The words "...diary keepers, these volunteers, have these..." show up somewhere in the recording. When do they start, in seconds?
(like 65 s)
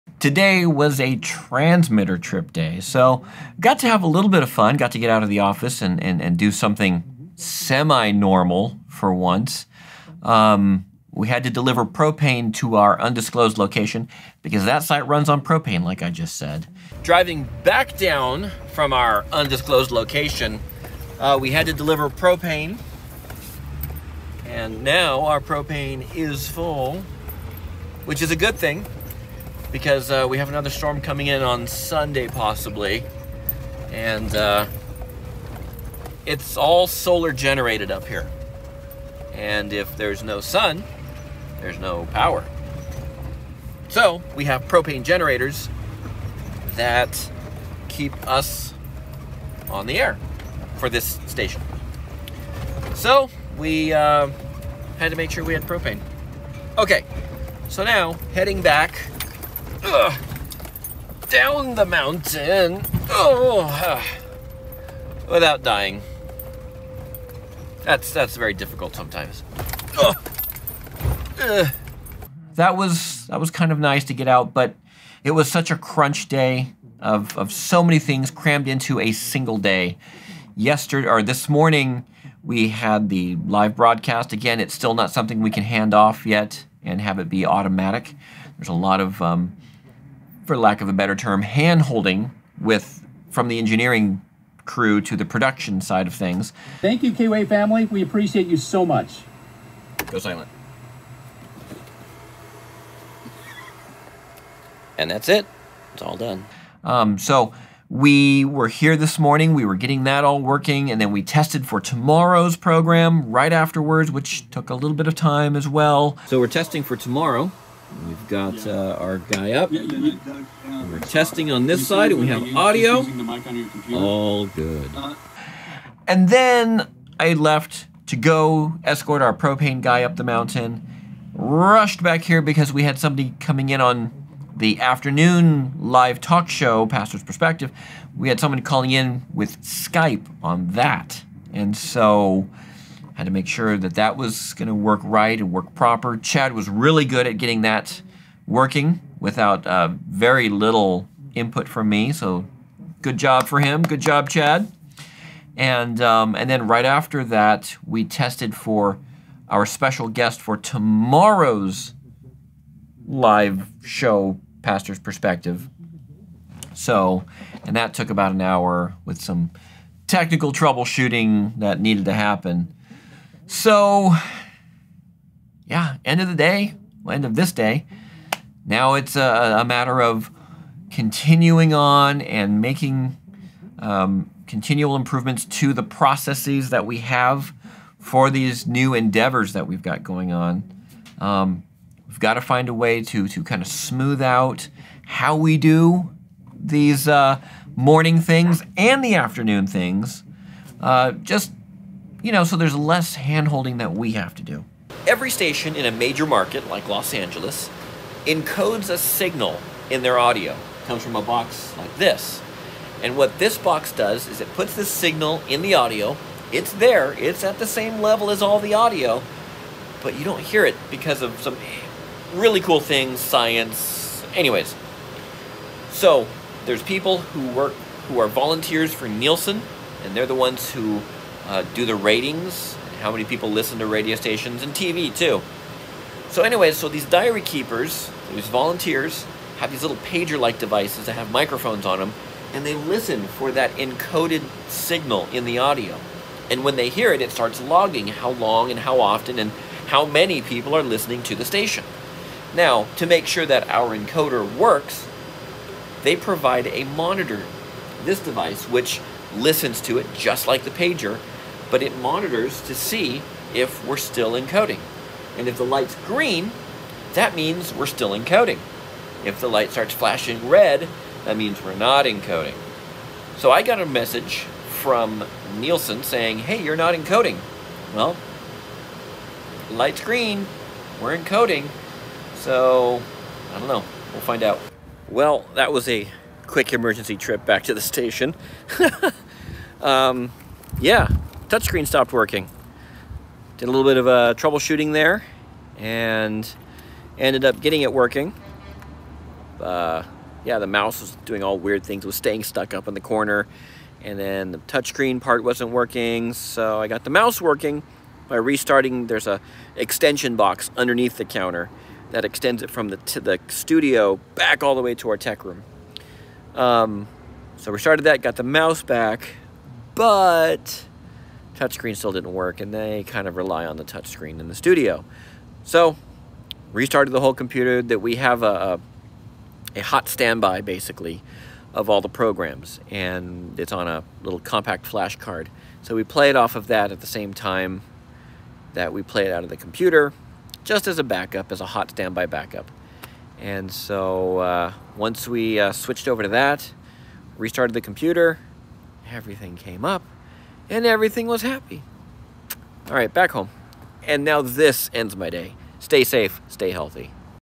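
237 s.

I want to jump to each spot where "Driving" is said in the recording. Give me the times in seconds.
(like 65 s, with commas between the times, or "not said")
17 s.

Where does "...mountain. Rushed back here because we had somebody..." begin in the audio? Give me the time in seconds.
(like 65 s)
130 s.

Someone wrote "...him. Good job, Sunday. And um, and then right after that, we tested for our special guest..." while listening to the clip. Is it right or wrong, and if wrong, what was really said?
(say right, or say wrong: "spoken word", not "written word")
wrong: "Chad", not "Sunday".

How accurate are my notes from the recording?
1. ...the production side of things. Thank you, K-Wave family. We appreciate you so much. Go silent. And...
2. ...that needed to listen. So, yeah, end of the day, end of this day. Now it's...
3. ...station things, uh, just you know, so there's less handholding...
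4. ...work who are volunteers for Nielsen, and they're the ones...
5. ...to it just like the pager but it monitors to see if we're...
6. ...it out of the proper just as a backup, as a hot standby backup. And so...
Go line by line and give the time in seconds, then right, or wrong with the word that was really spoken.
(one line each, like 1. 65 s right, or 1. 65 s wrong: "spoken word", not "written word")
1. 95 s right
2. 171 s wrong: "happen", not "listen"
3. 199 s wrong: "afternoon", not "station"
4. 227 s right
5. 259 s right
6. 339 s wrong: "computer", not "proper".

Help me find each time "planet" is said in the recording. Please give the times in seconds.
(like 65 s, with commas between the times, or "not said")
not said.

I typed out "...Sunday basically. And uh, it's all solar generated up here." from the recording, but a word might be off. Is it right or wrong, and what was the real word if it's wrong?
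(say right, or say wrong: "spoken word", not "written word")
wrong: "possibly", not "basically".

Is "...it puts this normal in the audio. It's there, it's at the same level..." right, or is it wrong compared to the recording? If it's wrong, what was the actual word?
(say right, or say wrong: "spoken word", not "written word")
wrong: "signal", not "normal".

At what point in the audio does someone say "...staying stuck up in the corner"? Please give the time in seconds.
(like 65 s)
302 s.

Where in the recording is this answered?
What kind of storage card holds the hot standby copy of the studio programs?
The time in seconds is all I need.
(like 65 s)
334 s.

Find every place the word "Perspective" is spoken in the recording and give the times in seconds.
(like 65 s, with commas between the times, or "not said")
137 s, 164 s.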